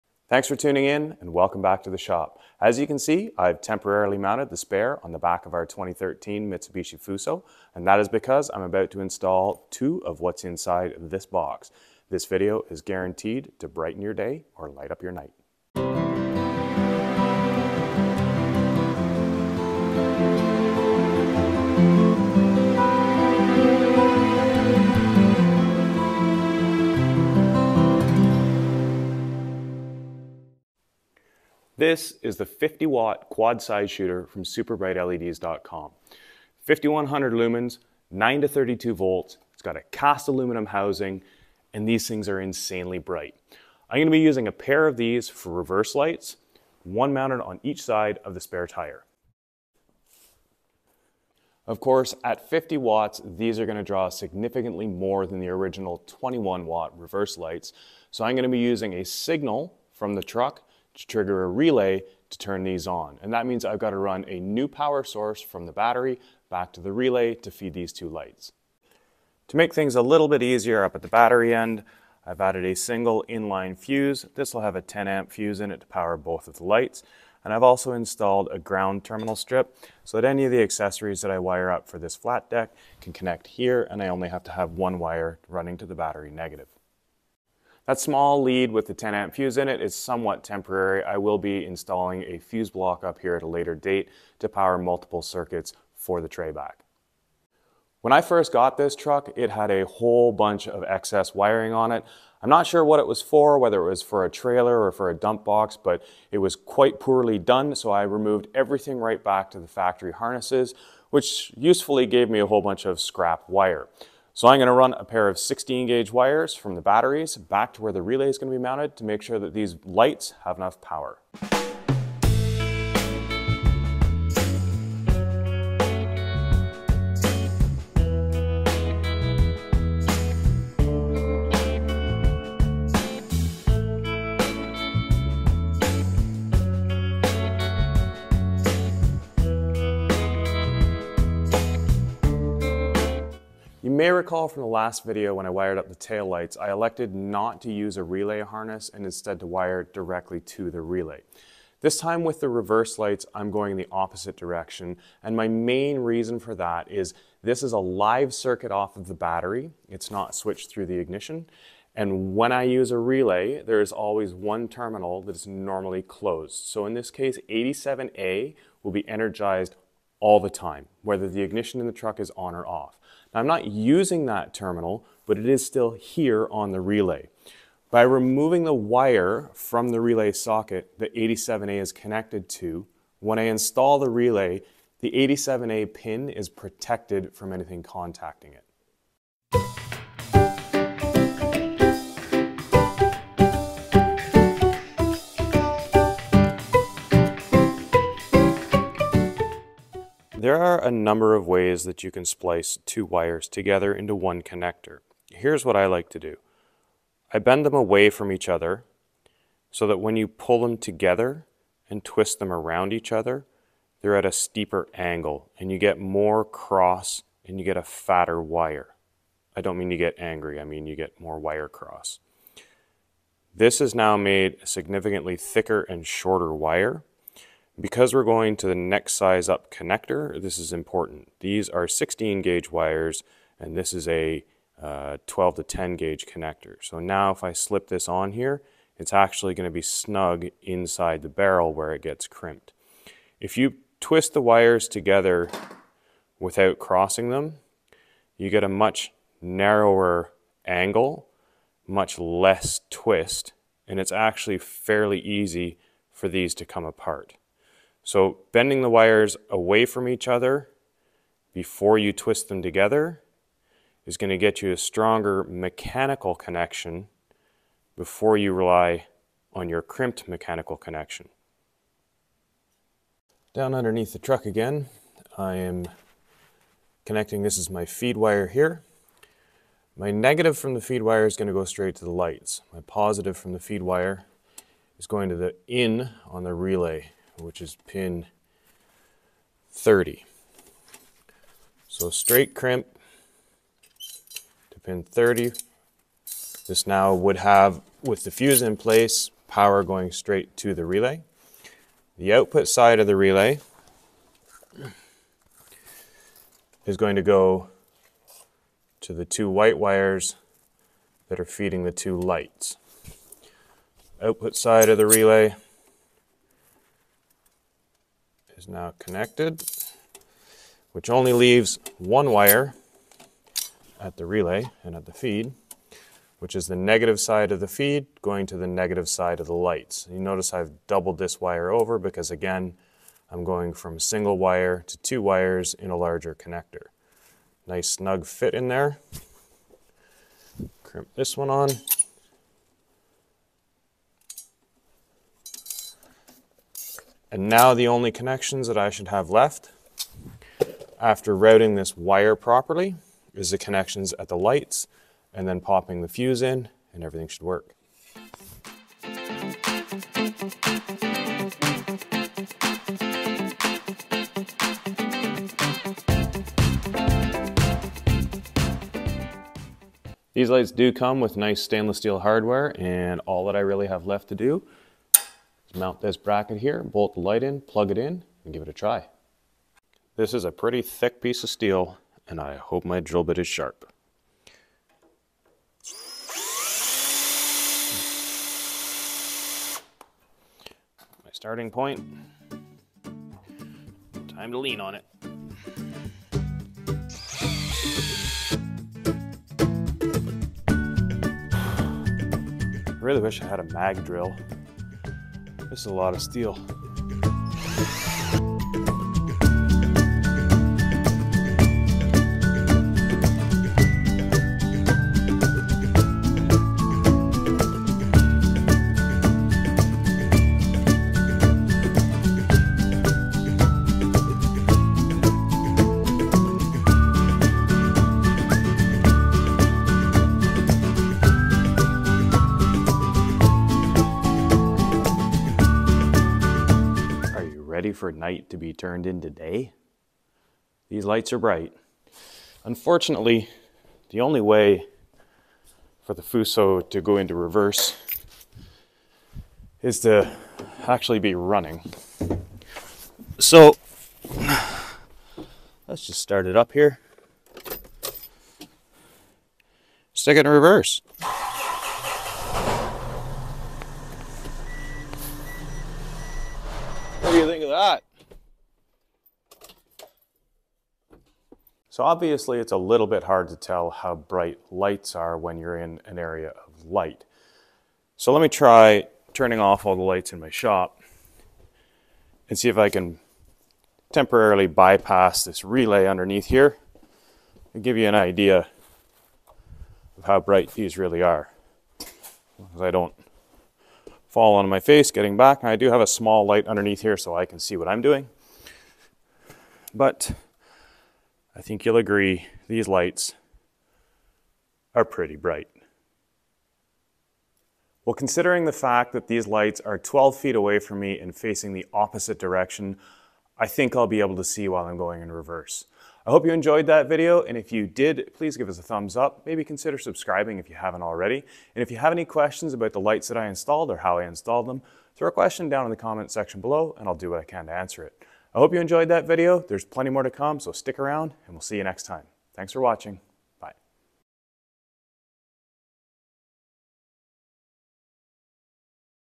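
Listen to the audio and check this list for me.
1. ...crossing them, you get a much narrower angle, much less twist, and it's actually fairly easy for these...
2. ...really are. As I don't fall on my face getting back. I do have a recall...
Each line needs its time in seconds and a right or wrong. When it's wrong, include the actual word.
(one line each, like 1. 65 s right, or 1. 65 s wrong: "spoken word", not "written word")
1. 246 s right
2. 490 s wrong: "small", not "recall".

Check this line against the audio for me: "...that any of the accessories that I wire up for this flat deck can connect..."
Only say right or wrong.
right.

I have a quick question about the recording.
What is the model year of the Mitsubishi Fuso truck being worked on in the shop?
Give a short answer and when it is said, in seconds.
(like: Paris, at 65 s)
2013, at 5 s.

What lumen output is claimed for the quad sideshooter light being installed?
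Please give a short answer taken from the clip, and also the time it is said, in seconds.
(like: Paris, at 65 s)
5100 lumens, at 36 s.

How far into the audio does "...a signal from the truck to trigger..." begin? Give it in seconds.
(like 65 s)
58 s.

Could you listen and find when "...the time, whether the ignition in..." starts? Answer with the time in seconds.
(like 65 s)
170 s.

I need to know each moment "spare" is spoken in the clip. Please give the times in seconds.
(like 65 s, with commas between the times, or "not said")
4 s, 48 s.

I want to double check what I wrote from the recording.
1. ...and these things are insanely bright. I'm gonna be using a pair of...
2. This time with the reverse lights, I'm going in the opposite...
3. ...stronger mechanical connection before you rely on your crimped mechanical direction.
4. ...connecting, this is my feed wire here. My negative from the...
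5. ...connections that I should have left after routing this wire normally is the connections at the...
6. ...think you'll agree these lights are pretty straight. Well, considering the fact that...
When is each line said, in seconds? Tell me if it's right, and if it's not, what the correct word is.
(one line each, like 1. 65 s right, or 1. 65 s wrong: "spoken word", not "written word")
1. 41 s right
2. 151 s right
3. 264 s wrong: "connection", not "direction"
4. 277 s right
5. 348 s wrong: "properly", not "normally"
6. 501 s wrong: "bright", not "straight".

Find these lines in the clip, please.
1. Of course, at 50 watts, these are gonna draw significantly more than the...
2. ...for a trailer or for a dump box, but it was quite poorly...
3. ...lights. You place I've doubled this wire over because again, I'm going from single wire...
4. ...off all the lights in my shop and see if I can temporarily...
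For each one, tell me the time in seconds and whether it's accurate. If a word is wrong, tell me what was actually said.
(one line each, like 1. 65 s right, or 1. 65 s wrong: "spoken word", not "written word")
1. 51 s right
2. 104 s right
3. 329 s wrong: "notice", not "place"
4. 479 s right.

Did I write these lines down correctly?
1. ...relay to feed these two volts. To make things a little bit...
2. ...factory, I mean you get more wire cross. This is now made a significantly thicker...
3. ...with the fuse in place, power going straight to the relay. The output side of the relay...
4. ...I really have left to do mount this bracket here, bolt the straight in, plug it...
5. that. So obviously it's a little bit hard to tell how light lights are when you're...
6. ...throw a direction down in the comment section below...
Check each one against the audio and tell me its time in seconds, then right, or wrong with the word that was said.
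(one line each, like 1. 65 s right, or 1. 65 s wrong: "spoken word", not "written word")
1. 66 s wrong: "lights", not "volts"
2. 220 s wrong: "angry", not "factory"
3. 298 s right
4. 373 s wrong: "light", not "straight"
5. 467 s wrong: "bright", not "light"
6. 525 s wrong: "question", not "direction".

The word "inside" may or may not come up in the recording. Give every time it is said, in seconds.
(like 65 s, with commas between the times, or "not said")
10 s, 240 s.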